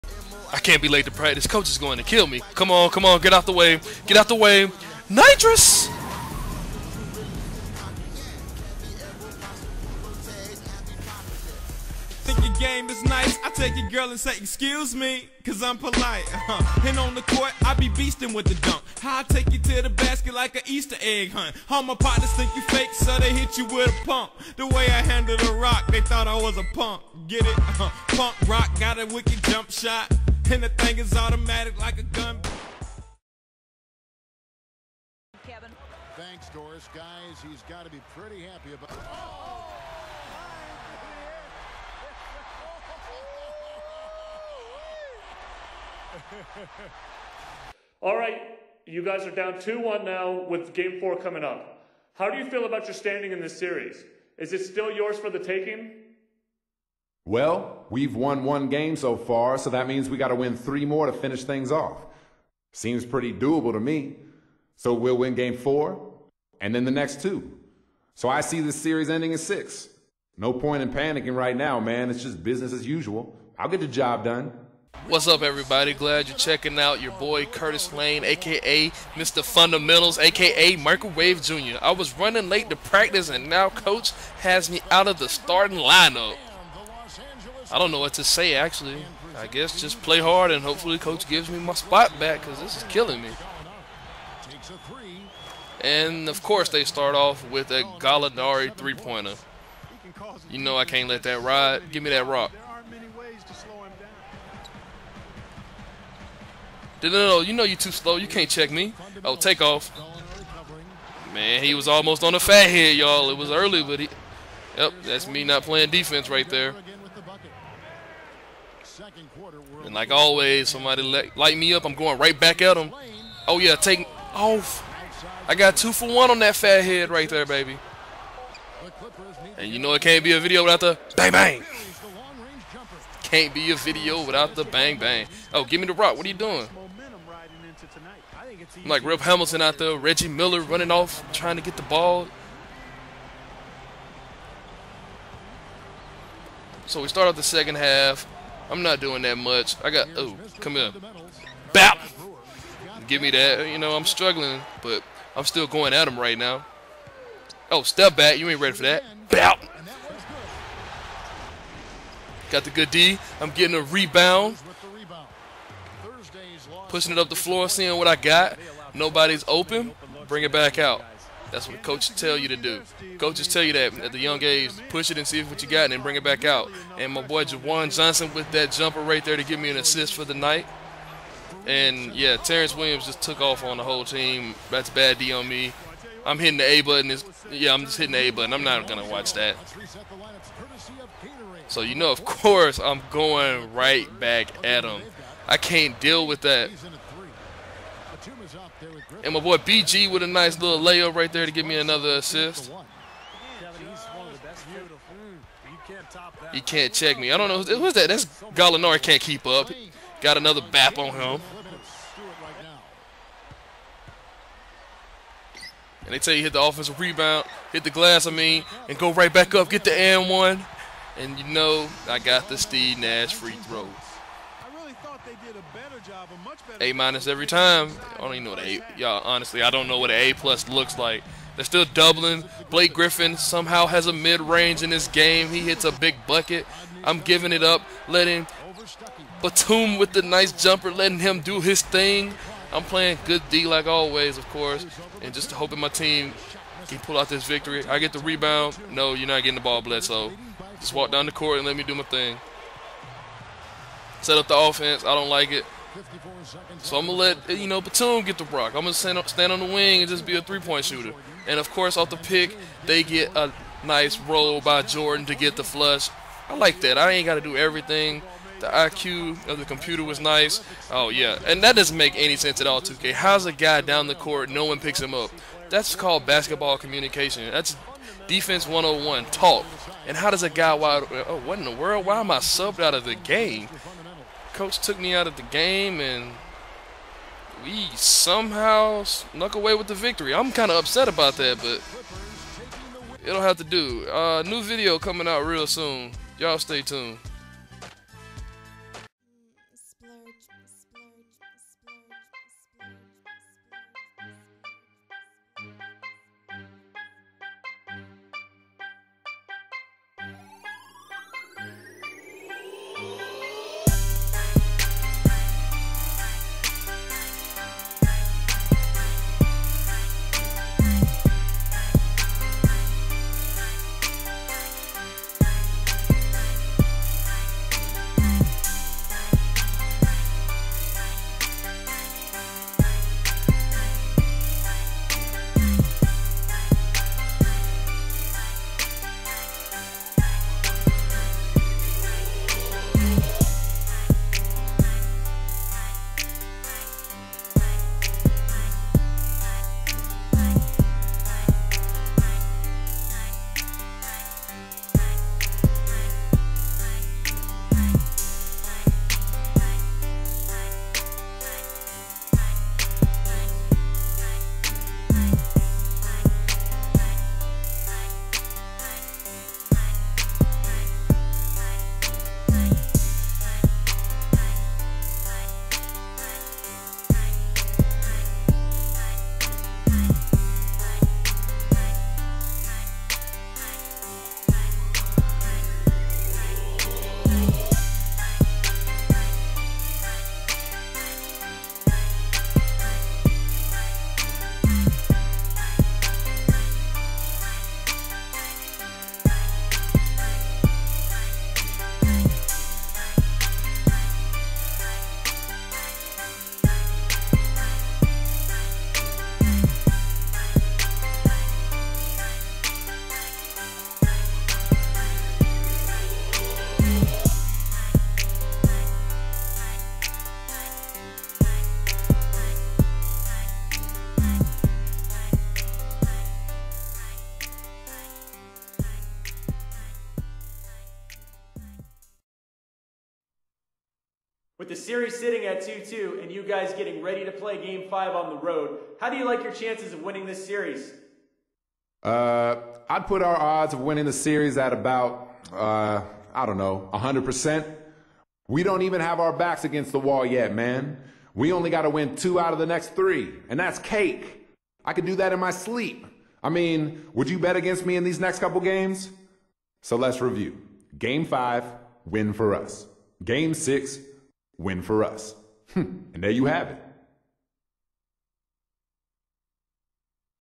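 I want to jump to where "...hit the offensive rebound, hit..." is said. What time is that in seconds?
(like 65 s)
216 s.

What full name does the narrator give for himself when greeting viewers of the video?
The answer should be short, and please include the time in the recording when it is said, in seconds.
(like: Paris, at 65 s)
Curtis Lane, at 77 s.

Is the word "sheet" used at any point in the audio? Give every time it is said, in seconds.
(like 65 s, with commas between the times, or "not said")
not said.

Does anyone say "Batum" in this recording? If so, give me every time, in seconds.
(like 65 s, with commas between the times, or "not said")
239 s, 257 s.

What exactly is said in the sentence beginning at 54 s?
Is it still yours for the taking?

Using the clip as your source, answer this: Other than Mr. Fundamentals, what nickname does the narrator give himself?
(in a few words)
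Microwave Jr.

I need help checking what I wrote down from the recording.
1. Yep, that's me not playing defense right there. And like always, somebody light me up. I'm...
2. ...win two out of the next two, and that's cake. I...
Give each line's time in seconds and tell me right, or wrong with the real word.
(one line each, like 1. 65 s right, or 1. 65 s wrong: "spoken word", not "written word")
1. 114 s right
2. 451 s wrong: "three", not "two".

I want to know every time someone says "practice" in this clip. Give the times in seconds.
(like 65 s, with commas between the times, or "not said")
1 s, 82 s.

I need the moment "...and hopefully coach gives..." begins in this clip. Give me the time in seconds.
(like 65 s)
90 s.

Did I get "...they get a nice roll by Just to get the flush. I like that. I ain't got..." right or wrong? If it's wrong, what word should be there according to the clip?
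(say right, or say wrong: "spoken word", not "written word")
wrong: "Jordan", not "Just".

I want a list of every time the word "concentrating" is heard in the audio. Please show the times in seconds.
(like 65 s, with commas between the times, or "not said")
not said.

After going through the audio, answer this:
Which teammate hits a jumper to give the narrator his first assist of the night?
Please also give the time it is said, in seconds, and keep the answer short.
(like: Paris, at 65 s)
Jawan Johnson, at 177 s.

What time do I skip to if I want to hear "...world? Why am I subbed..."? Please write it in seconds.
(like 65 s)
281 s.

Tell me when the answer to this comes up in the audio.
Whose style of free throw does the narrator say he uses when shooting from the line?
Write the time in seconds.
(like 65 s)
222 s.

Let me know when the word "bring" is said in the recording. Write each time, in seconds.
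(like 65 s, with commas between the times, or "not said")
170 s, 176 s.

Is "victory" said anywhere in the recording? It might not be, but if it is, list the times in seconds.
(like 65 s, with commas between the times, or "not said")
247 s, 289 s.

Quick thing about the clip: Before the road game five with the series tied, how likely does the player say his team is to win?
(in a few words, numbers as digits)
100%.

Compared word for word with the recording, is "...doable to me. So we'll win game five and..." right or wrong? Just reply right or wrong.
wrong.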